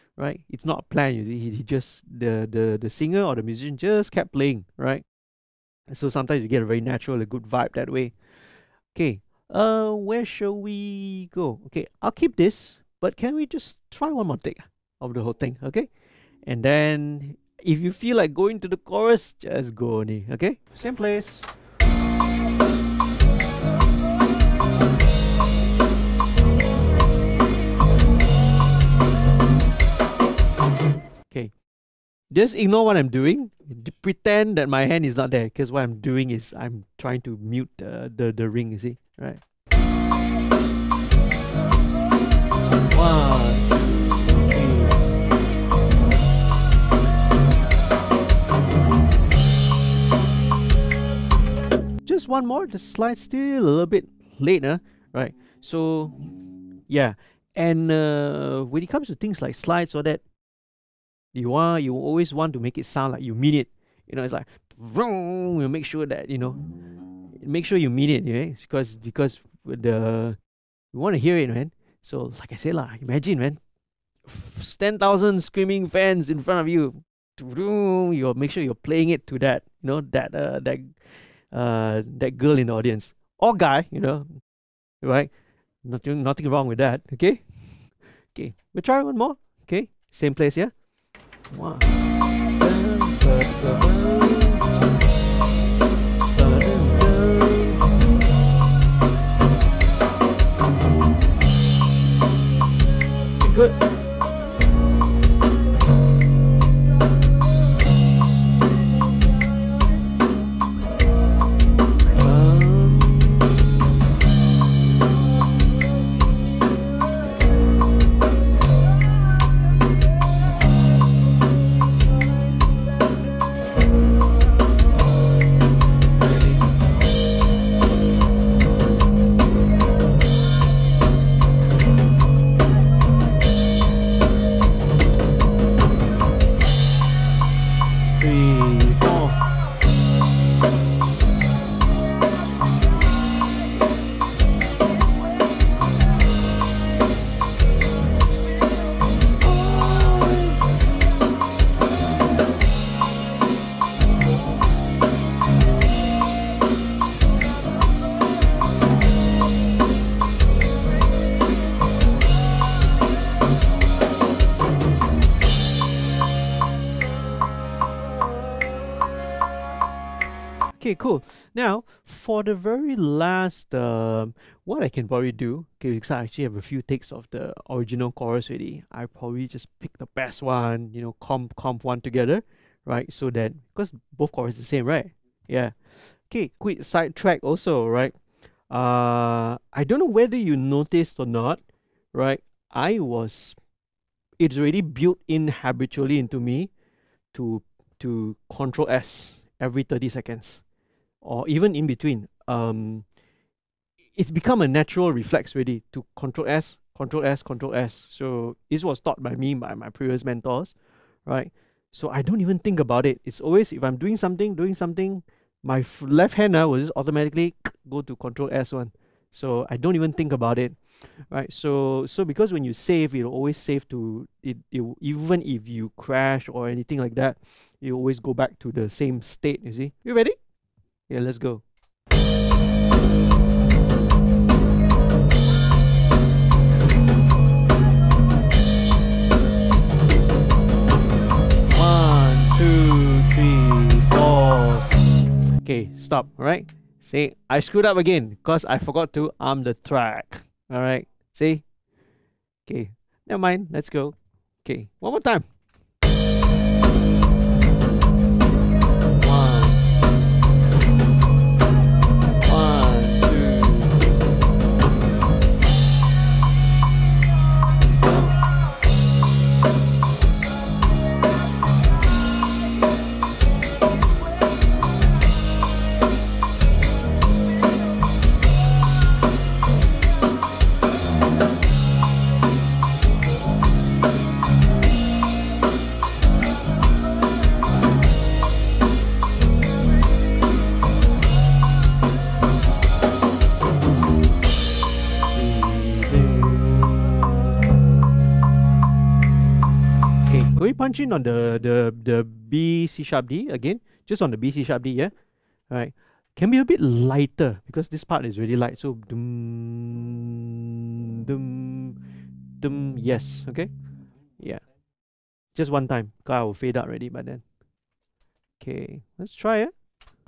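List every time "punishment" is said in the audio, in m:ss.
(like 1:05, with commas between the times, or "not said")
not said.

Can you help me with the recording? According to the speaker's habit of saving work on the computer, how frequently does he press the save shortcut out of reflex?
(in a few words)
every 30 seconds.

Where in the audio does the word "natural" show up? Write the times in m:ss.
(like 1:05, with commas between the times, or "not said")
0:06, 3:24.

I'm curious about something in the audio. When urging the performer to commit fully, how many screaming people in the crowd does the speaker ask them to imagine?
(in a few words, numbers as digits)
10,000.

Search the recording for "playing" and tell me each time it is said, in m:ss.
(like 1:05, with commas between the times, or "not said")
0:04, 1:18.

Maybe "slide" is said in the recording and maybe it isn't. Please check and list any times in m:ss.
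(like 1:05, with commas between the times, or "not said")
0:52, 0:59.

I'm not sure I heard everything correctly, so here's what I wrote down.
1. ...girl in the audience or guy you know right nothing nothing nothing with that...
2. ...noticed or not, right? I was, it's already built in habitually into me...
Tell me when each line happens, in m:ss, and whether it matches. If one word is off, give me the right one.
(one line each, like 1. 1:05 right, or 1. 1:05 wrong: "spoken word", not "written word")
1. 1:22 wrong: "wrong", not "nothing"
2. 3:10 right.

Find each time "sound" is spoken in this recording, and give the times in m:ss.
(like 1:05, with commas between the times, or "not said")
1:02.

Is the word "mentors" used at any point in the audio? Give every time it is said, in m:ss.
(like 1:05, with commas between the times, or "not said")
3:30.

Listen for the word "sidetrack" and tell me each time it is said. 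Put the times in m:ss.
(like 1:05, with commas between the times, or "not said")
3:06.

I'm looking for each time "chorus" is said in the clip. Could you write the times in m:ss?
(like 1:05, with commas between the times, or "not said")
0:18, 2:58, 3:04.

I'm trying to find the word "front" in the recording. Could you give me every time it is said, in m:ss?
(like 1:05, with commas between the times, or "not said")
1:16.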